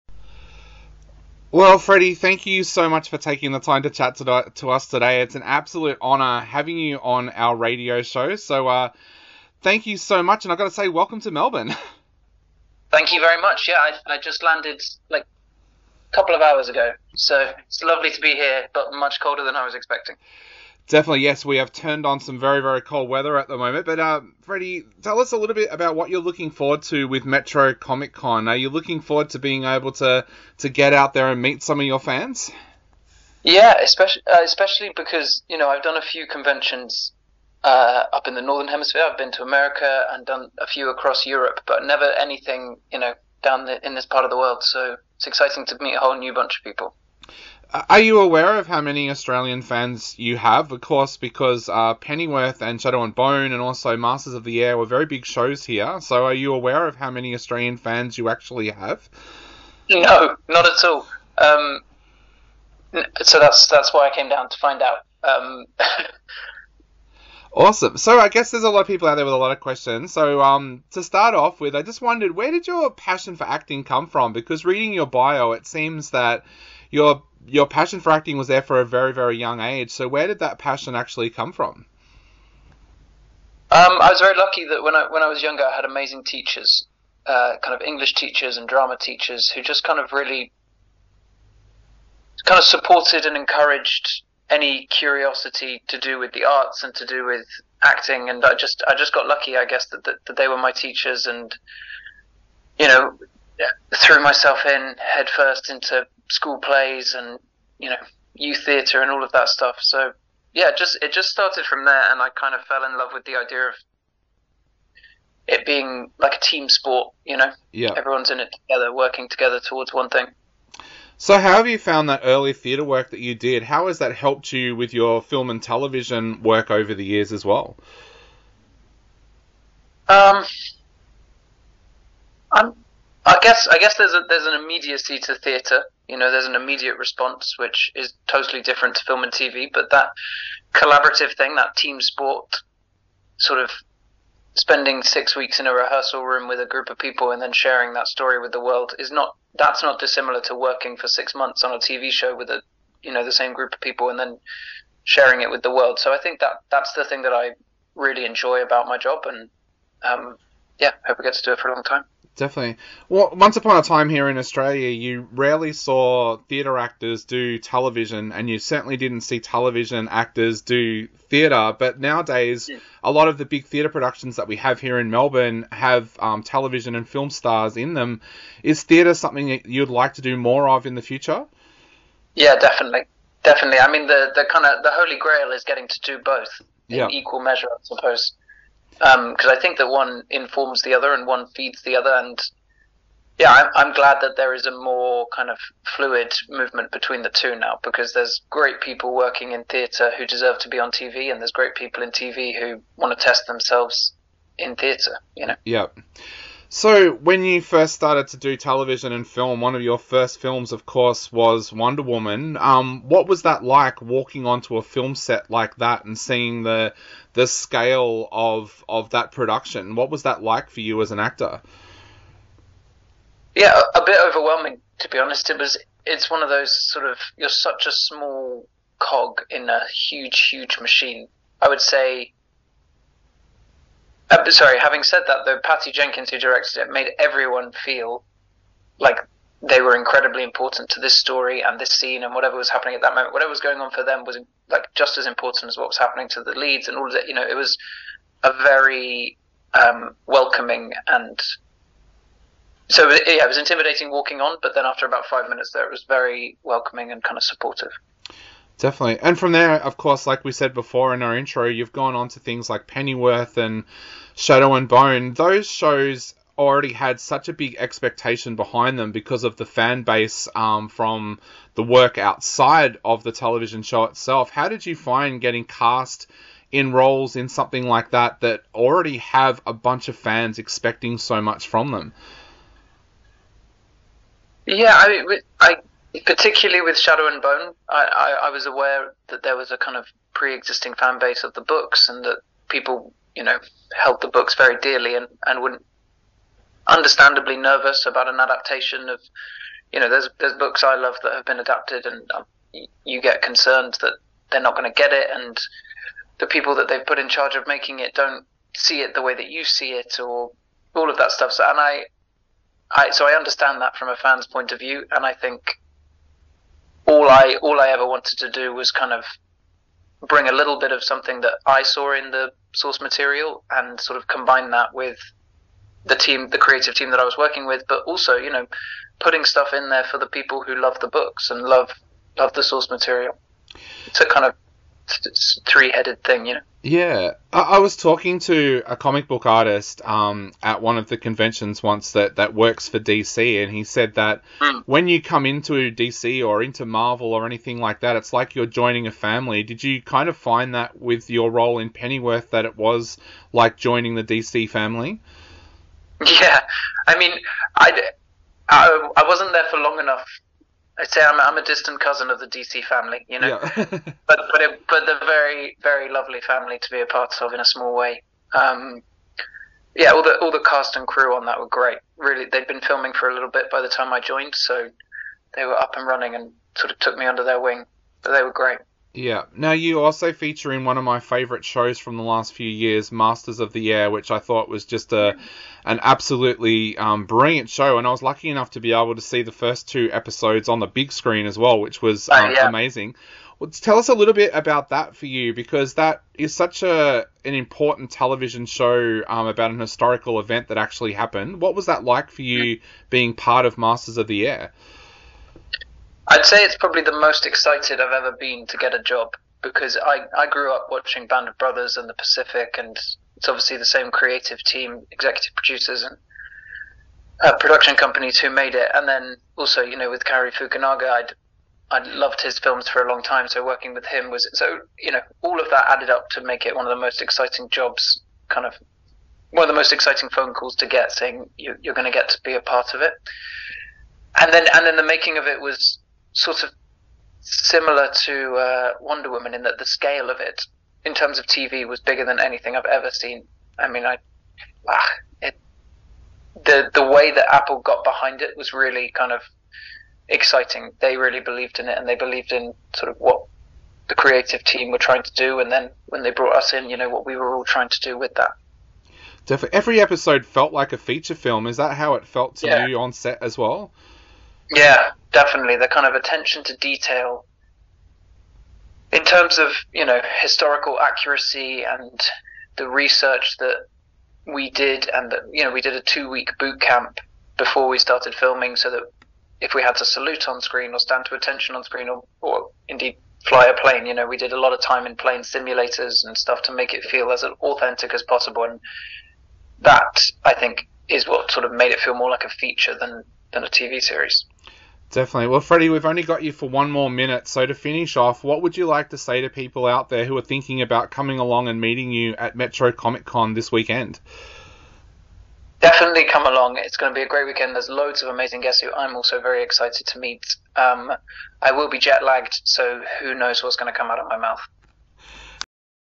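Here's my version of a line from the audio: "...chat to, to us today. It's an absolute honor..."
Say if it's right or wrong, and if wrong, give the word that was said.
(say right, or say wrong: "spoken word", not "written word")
right.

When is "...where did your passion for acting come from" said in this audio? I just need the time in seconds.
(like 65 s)
72 s.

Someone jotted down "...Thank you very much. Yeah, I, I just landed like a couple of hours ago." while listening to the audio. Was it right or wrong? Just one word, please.
right.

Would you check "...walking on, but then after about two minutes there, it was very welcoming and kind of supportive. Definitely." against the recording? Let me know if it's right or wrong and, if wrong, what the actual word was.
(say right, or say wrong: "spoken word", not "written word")
wrong: "five", not "two".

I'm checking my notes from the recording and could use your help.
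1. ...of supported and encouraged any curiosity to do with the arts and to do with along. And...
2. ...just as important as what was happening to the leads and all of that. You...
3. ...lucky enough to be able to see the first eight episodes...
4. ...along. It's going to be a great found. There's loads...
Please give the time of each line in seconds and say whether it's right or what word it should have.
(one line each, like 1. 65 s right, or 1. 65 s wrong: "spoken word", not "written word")
1. 92 s wrong: "acting", not "along"
2. 244 s right
3. 388 s wrong: "two", not "eight"
4. 506 s wrong: "weekend", not "found".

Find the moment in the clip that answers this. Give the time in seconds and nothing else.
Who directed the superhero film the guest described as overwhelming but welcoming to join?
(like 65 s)
235 s.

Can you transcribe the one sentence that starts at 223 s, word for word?
Yeah, a, a bit overwhelming to be honest.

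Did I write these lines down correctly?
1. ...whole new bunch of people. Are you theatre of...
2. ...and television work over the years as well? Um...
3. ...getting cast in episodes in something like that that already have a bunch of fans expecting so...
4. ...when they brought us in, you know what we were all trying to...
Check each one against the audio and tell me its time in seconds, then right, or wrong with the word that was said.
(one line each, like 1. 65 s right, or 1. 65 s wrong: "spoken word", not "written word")
1. 45 s wrong: "aware", not "theatre"
2. 125 s right
3. 275 s wrong: "roles", not "episodes"
4. 456 s right.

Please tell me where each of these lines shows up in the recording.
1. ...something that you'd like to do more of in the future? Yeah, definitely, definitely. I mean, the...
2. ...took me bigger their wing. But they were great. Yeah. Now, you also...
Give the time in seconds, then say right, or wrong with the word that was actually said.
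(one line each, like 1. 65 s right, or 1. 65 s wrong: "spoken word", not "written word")
1. 179 s right
2. 376 s wrong: "under", not "bigger".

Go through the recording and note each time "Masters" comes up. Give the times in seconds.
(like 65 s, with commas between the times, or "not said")
53 s, 383 s, 403 s.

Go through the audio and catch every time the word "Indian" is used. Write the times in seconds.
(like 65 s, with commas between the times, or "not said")
not said.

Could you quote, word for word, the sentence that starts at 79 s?
So where did that passion actually come from?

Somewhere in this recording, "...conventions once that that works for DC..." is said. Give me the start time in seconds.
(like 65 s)
341 s.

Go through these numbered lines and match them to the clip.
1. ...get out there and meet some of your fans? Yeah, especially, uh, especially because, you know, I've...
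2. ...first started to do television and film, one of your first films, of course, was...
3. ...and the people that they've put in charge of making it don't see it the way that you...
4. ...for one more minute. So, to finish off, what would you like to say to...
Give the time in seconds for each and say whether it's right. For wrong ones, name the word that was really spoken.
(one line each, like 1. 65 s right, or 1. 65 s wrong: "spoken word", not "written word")
1. 30 s right
2. 207 s right
3. 305 s right
4. 496 s right.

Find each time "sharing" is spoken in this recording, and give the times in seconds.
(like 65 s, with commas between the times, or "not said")
147 s, 155 s.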